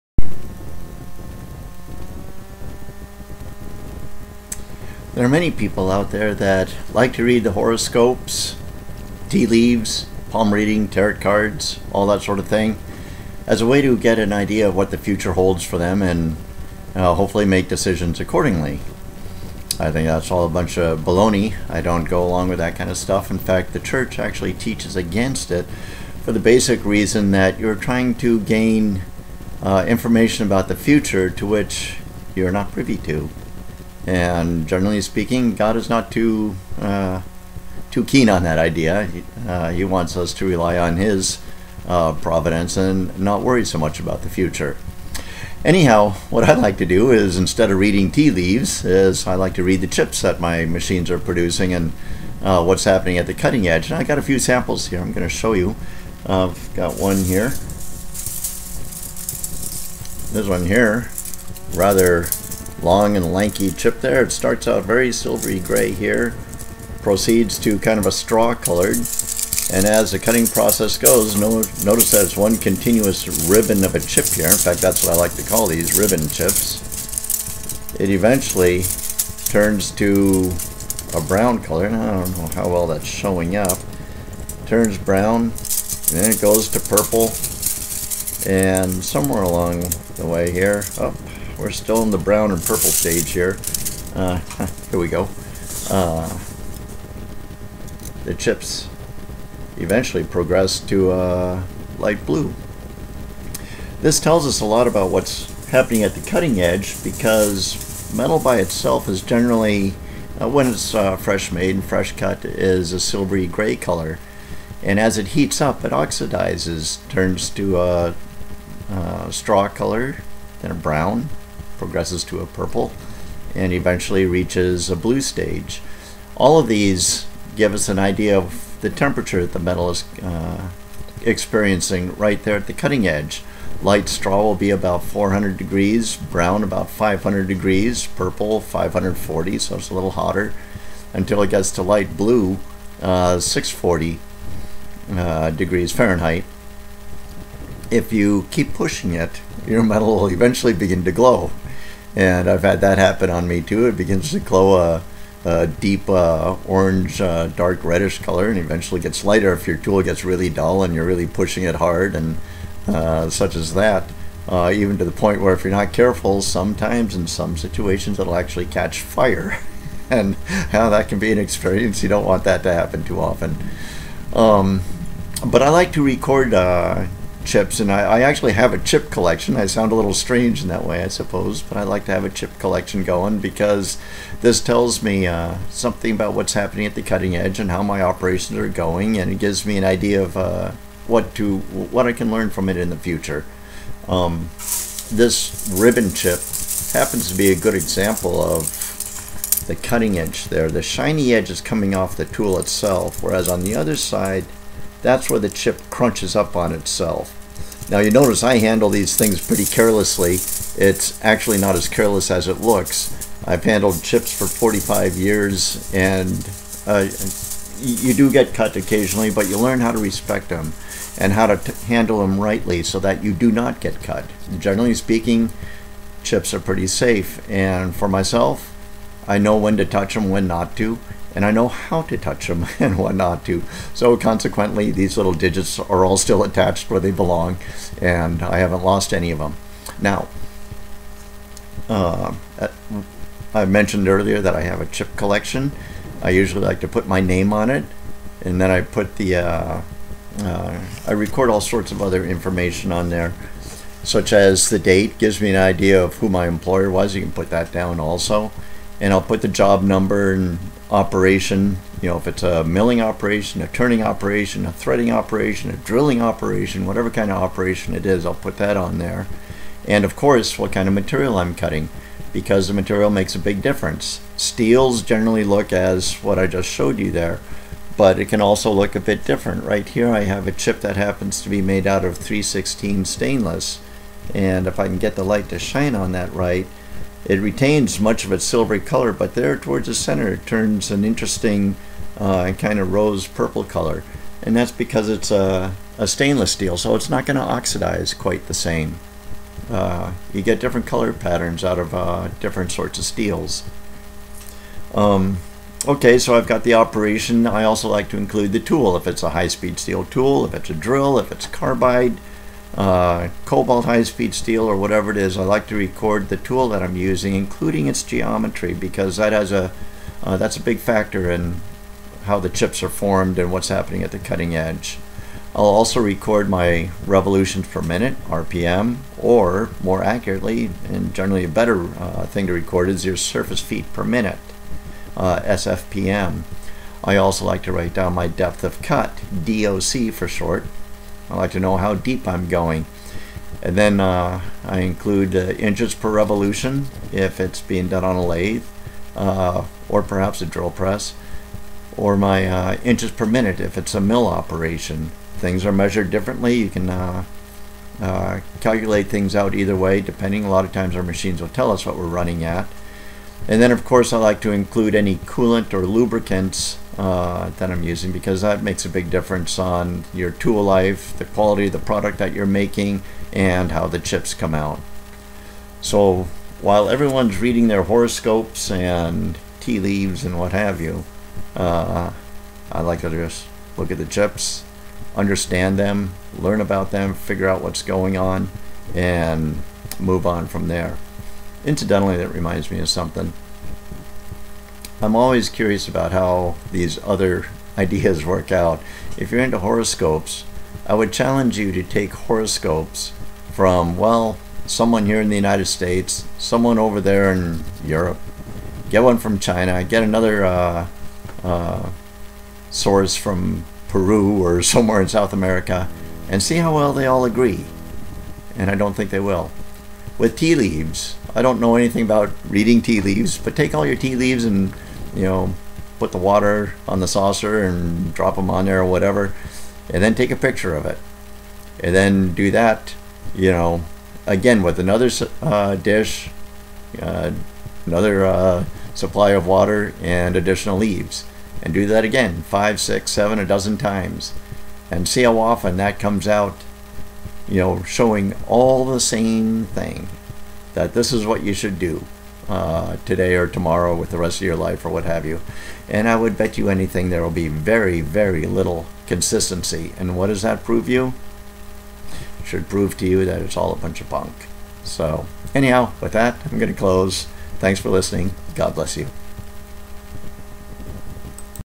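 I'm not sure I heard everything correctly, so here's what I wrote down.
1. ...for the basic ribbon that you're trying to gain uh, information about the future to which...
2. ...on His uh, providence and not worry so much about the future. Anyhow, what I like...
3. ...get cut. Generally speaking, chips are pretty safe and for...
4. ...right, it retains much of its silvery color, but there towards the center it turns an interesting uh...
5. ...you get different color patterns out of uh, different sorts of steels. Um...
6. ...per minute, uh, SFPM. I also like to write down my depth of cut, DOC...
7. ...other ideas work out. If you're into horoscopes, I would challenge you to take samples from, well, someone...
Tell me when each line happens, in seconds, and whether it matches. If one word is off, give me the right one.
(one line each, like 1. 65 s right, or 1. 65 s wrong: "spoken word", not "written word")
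1. 26 s wrong: "reason", not "ribbon"
2. 40 s right
3. 223 s right
4. 286 s right
5. 300 s right
6. 333 s right
7. 397 s wrong: "horoscopes", not "samples".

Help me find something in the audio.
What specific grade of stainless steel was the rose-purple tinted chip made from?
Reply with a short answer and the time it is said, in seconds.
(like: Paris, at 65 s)
316, at 282 s.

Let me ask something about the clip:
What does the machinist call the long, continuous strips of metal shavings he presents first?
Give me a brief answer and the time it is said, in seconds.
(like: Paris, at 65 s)
ribbon chips, at 75 s.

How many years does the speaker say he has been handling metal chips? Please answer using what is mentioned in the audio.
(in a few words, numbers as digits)
45 years.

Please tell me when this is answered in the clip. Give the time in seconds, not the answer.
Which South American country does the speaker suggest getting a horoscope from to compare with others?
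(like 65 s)
413 s.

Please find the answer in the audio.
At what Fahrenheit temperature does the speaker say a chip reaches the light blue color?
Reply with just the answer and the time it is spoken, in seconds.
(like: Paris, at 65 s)
640 degrees, at 143 s.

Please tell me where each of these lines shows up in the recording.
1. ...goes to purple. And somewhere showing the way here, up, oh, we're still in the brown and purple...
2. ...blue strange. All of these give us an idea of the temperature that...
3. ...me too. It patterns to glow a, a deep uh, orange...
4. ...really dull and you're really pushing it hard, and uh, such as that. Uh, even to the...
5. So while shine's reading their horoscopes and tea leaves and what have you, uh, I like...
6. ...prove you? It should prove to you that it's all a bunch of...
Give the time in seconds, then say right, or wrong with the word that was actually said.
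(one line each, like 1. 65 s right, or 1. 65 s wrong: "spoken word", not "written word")
1. 86 s wrong: "along", not "showing"
2. 124 s wrong: "stage", not "strange"
3. 153 s wrong: "begins", not "patterns"
4. 160 s right
5. 375 s wrong: "everyone", not "shine"
6. 460 s right.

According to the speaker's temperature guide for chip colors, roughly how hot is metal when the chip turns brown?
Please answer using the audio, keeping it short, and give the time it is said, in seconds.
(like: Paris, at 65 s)
500 degrees, at 136 s.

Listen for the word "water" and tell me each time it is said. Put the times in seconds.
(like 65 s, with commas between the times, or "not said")
426 s, 439 s.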